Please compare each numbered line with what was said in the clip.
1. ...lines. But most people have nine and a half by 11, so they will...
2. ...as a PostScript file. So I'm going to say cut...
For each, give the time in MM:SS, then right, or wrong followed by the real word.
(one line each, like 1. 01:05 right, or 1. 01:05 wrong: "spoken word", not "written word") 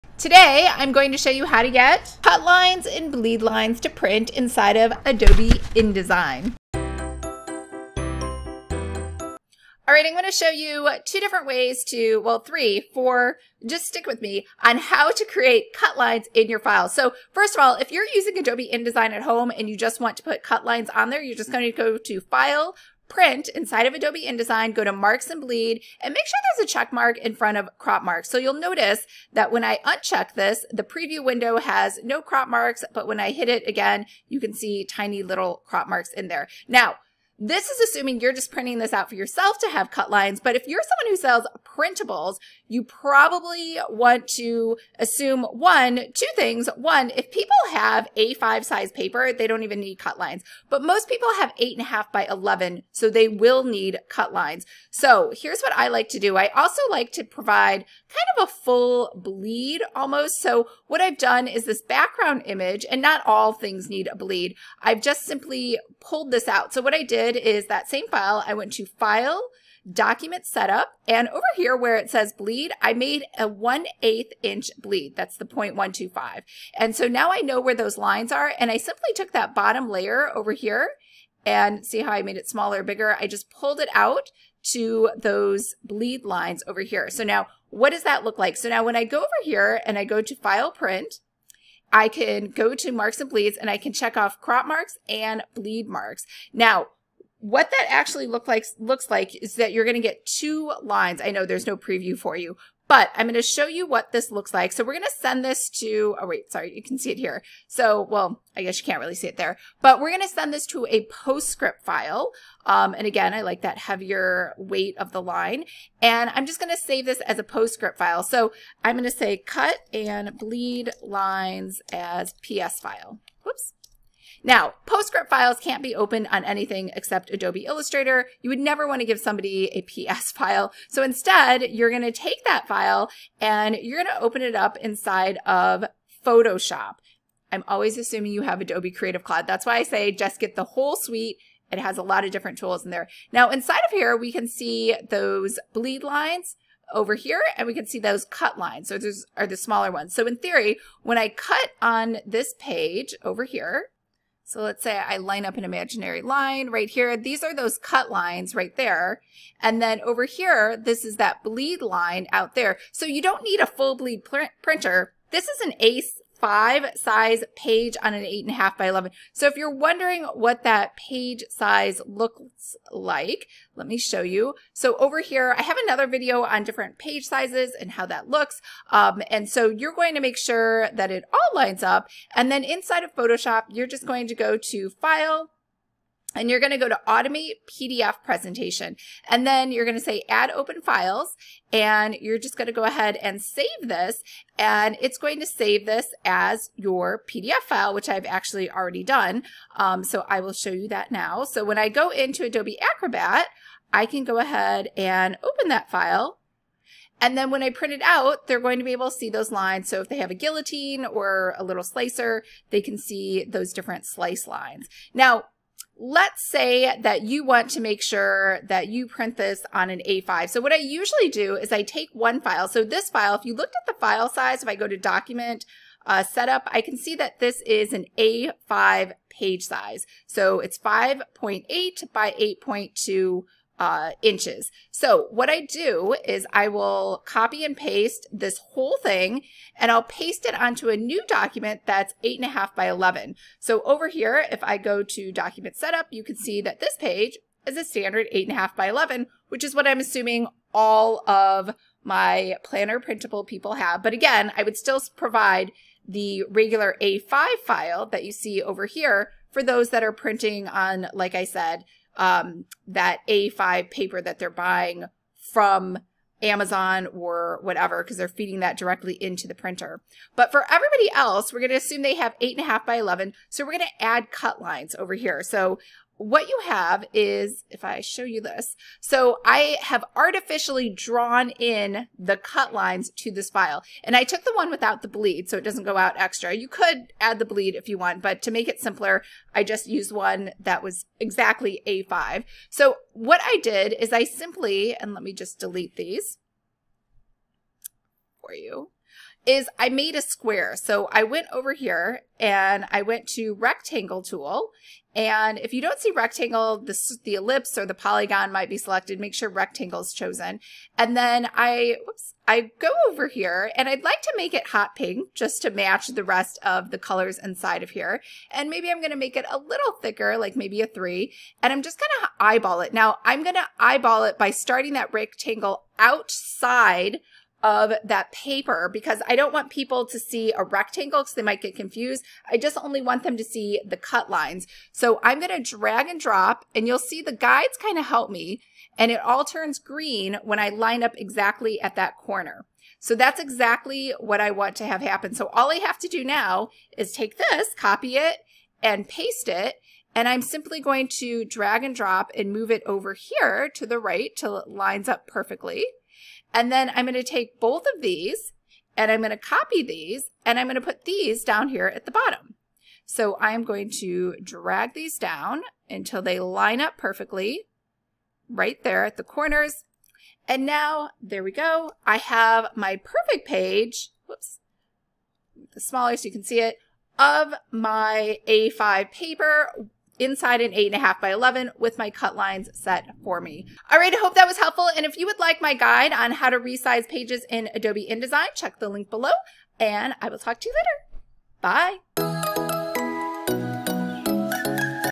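1. 00:50 wrong: "eight", not "nine"
2. 01:57 right.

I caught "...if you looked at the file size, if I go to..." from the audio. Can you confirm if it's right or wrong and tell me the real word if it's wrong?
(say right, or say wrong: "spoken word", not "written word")
right.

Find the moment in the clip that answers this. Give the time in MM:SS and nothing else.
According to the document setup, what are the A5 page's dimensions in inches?
03:50.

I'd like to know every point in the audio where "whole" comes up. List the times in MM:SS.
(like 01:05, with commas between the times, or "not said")
02:20, 03:58.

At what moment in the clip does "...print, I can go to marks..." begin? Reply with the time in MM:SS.
01:30.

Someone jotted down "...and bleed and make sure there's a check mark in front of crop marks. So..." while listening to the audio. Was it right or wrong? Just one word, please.
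right.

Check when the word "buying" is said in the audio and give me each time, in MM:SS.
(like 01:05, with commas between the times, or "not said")
04:24.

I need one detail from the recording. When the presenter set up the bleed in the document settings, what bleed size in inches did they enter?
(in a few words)
1/8 inch.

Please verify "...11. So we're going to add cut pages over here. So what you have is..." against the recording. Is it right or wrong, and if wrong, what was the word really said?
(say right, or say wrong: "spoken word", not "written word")
wrong: "lines", not "pages".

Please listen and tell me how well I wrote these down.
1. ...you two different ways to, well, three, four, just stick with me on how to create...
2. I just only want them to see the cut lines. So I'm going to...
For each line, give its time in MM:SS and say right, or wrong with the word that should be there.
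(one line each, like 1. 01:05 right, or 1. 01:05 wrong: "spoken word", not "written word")
1. 00:10 right
2. 05:32 right.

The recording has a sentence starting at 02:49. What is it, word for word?
So if you're wondering what that page size looks like, let me show you.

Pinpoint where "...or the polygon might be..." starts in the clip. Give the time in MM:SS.
05:07.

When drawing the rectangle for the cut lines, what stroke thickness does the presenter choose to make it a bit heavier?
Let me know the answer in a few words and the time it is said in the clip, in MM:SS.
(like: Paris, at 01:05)
3, at 05:20.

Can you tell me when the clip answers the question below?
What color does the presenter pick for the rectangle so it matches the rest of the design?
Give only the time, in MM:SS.
05:14.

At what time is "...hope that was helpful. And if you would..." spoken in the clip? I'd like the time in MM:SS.
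06:24.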